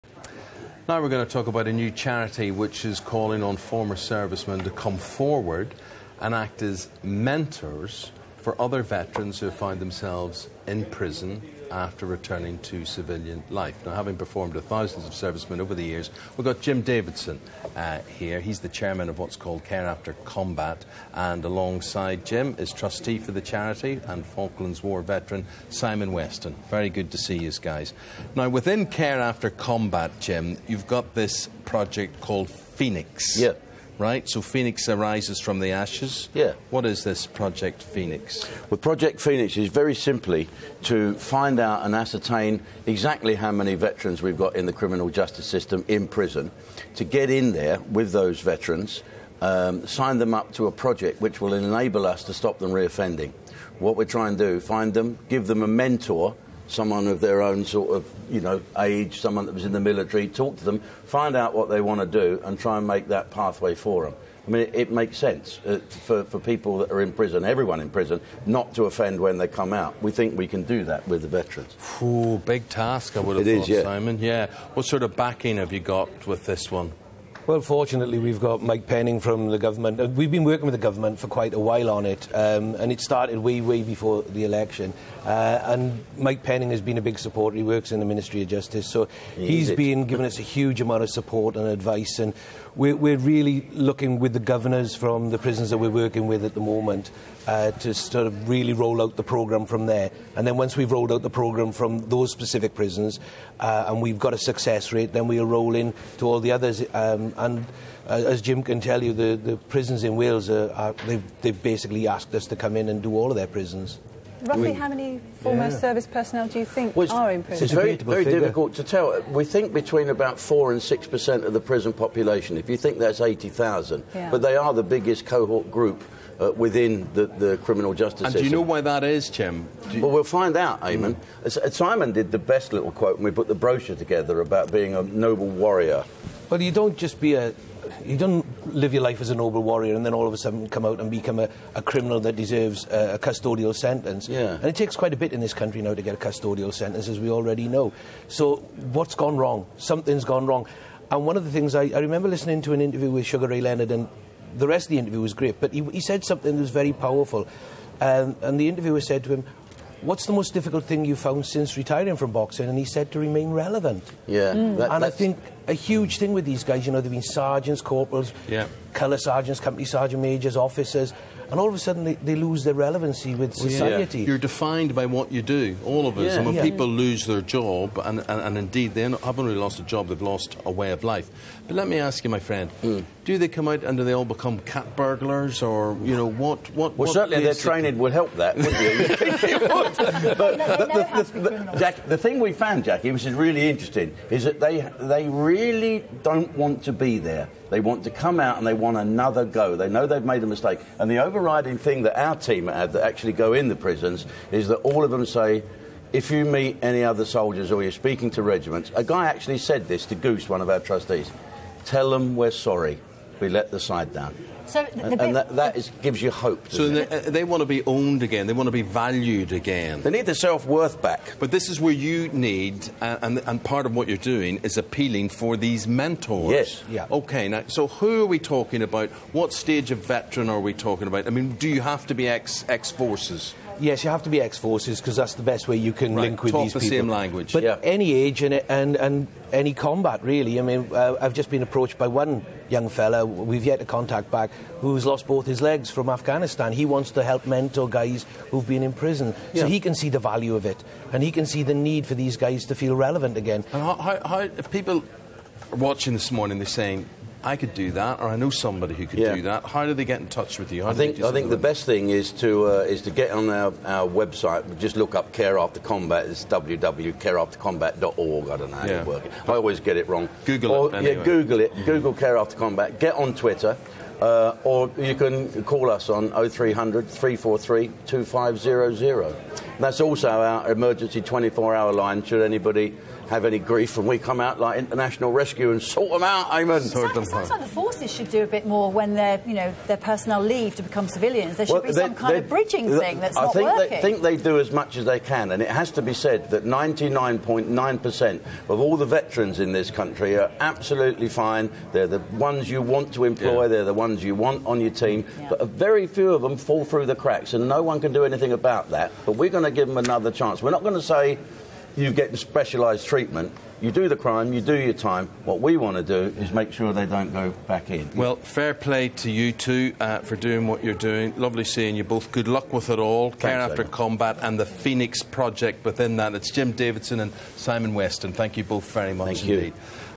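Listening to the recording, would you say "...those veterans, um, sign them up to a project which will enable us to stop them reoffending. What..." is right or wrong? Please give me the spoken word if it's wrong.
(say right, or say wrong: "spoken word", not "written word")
right.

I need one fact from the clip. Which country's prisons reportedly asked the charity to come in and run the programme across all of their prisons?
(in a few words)
Wales.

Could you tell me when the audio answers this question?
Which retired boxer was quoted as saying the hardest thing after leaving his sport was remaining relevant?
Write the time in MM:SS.
02:33.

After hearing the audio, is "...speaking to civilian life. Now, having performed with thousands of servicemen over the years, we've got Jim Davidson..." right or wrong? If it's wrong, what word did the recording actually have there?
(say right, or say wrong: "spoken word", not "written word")
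wrong: "returning", not "speaking".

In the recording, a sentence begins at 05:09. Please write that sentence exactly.
But we're going going to give them another chance.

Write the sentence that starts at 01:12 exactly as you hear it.
Ooh, big task, I would have it thought, is, yeah.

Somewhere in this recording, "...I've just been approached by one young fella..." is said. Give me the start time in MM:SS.
04:01.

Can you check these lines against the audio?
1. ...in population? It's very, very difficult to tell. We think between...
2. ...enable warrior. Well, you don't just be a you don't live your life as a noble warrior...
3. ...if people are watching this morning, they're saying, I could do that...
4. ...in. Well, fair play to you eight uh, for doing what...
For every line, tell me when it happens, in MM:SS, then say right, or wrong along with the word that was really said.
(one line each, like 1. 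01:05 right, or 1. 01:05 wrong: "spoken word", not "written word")
1. 01:57 wrong: "prison", not "population"
2. 02:15 wrong: "noble", not "enable"
3. 04:14 right
4. 05:17 wrong: "two", not "eight".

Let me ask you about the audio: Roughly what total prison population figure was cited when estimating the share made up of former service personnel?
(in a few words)
80,000.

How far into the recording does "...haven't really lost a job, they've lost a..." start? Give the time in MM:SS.
02:59.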